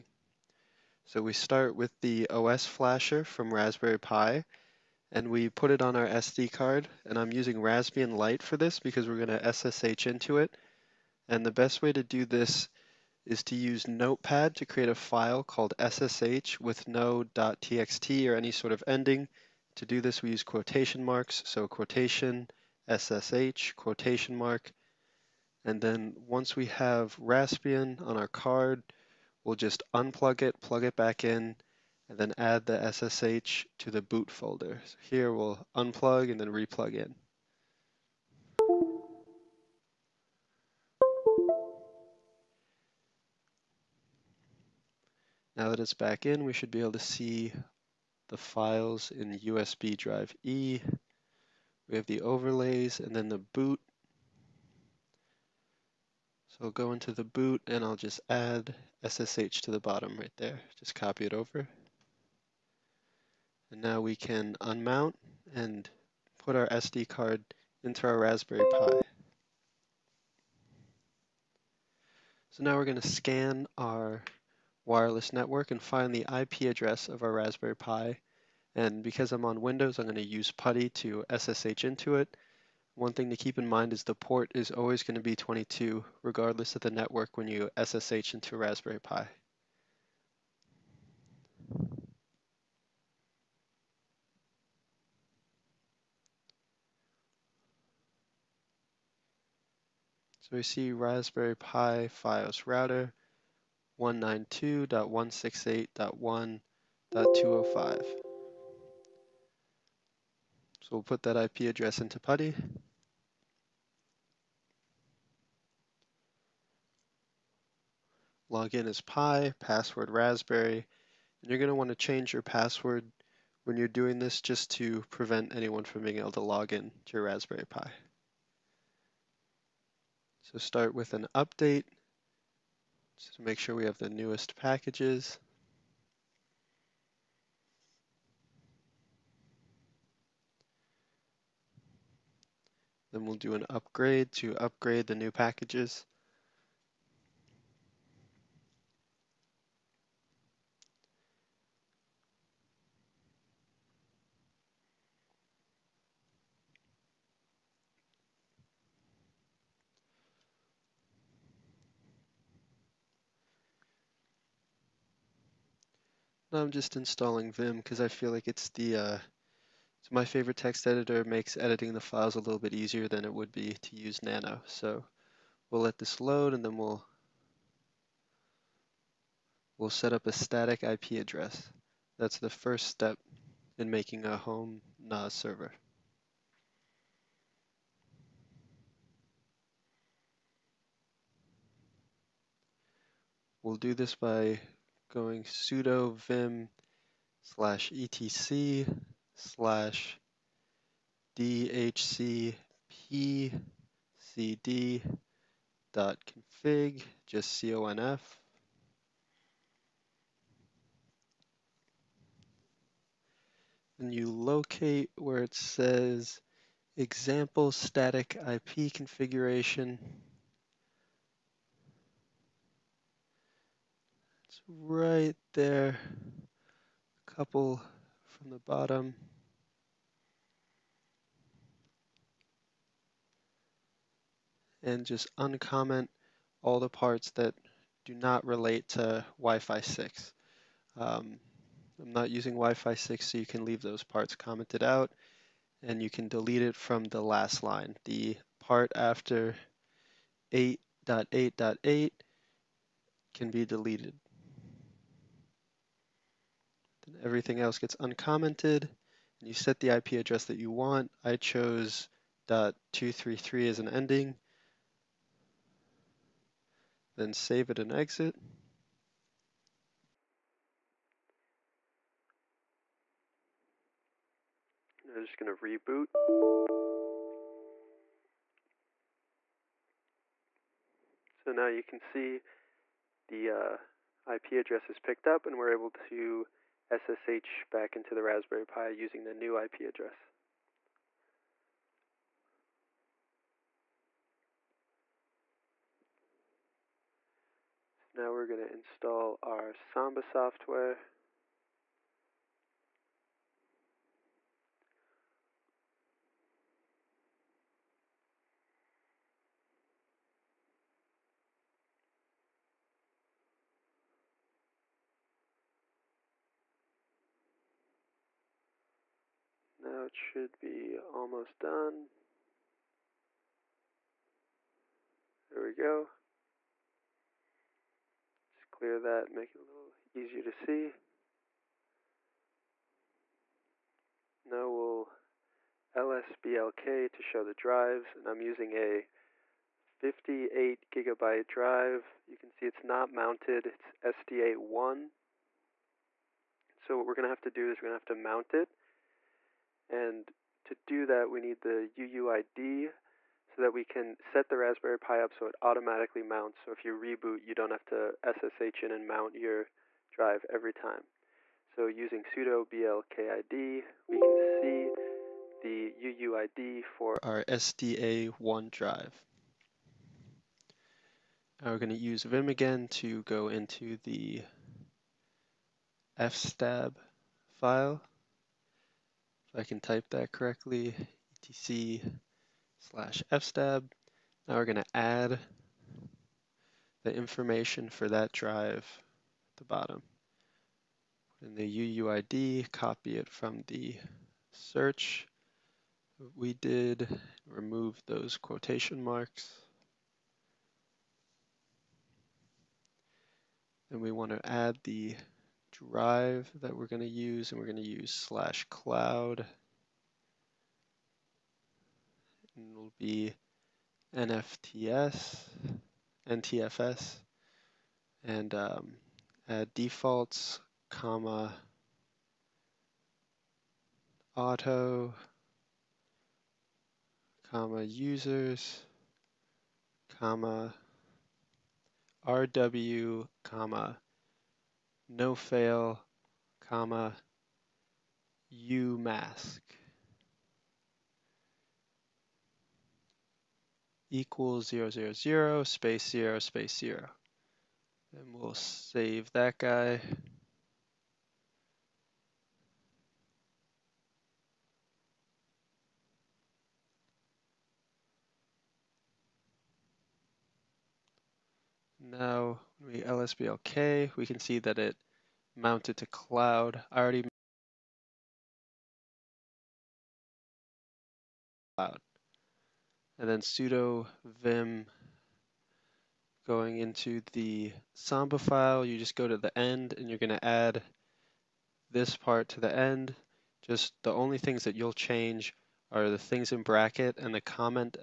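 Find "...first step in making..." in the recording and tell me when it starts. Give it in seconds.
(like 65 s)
182 s.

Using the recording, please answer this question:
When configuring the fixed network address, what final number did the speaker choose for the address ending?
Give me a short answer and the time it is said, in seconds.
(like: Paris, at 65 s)
.233, at 262 s.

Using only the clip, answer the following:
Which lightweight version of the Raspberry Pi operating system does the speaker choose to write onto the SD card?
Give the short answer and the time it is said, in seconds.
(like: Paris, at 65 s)
Raspbian Lite, at 7 s.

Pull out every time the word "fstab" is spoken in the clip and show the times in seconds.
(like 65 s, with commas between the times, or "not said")
376 s, 383 s.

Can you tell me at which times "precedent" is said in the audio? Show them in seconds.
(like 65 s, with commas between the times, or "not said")
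not said.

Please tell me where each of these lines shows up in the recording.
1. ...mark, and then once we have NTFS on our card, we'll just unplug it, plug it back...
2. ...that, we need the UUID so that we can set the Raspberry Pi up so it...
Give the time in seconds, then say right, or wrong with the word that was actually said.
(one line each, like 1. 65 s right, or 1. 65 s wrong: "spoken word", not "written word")
1. 24 s wrong: "Raspbian", not "NTFS"
2. 351 s right.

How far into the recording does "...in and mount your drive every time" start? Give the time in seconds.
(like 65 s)
358 s.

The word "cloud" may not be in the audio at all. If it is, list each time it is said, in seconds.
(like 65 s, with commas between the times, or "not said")
408 s, 466 s, 471 s.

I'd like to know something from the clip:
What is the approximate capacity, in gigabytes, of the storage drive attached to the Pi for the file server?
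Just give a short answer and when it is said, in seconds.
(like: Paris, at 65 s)
58, at 339 s.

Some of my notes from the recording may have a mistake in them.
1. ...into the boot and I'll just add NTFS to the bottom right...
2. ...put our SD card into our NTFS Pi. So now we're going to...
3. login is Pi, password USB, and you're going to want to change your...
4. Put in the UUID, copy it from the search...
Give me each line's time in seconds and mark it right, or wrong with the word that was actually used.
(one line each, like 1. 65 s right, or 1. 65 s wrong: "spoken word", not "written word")
1. 56 s wrong: "SSH", not "NTFS"
2. 66 s wrong: "Raspberry", not "NTFS"
3. 118 s wrong: "Raspberry", not "USB"
4. 391 s right.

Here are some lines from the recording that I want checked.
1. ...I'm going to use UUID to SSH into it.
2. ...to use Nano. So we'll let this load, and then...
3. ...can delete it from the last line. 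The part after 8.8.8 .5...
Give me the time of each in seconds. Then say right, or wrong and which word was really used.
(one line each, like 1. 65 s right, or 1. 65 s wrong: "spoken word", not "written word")
1. 79 s wrong: "PuTTY", not "UUID"
2. 173 s right
3. 246 s wrong: "8", not "5".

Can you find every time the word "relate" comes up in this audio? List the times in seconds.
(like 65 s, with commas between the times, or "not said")
238 s.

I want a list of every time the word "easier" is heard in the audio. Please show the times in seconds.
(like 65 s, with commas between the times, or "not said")
172 s, 330 s.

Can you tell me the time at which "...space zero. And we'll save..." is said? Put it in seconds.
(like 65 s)
446 s.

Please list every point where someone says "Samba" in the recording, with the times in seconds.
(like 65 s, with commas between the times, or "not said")
299 s, 477 s.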